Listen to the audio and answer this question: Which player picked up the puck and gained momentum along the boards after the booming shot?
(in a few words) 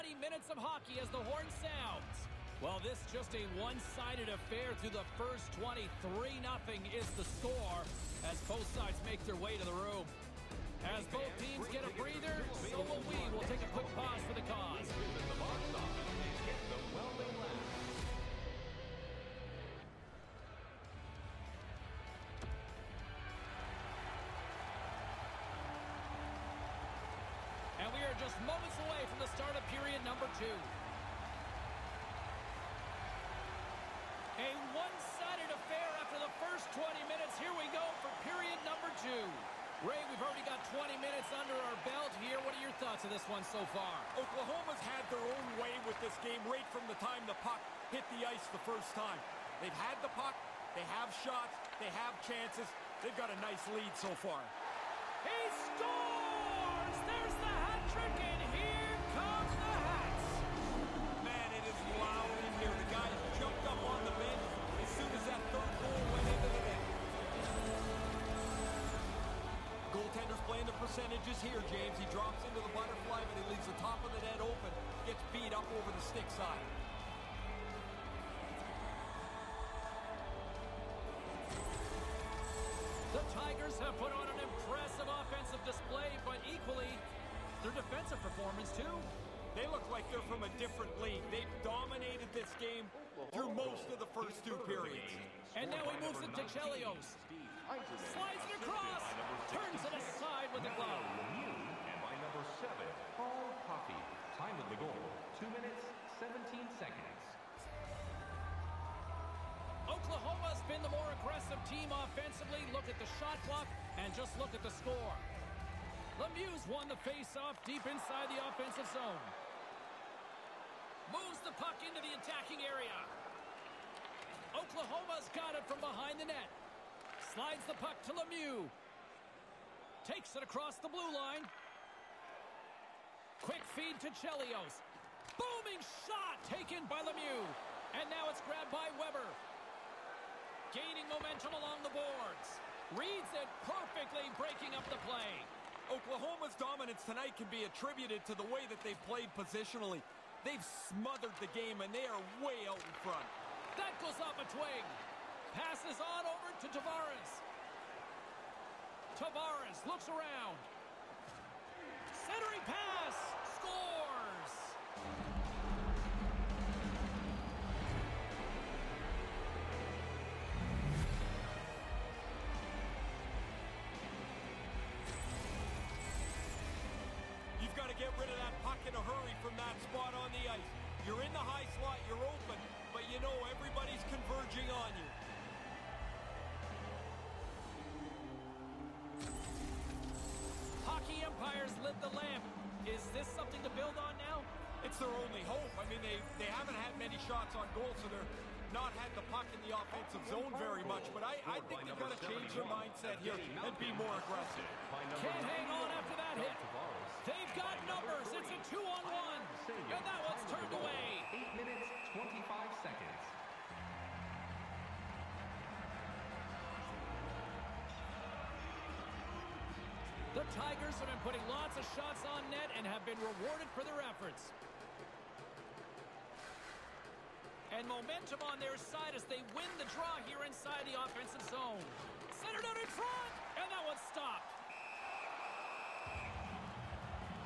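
Weber.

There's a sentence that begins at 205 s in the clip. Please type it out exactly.
Can't hang on after that hit.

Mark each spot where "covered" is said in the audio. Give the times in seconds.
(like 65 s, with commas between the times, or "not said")
not said.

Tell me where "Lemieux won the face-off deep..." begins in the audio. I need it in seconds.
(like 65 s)
116 s.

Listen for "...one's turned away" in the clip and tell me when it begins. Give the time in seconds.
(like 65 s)
210 s.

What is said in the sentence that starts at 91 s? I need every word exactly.
They've dominated this game through most of the first two periods.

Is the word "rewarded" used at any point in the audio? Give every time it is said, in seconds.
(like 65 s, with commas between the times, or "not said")
223 s.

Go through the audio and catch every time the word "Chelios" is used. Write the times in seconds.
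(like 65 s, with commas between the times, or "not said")
96 s, 134 s.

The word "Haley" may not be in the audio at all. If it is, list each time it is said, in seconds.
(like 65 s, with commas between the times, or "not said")
not said.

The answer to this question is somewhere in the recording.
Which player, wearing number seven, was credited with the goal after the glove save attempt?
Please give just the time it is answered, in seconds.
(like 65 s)
103 s.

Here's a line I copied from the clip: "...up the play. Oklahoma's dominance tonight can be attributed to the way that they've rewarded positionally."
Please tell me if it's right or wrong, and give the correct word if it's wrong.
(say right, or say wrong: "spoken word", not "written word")
wrong: "played", not "rewarded".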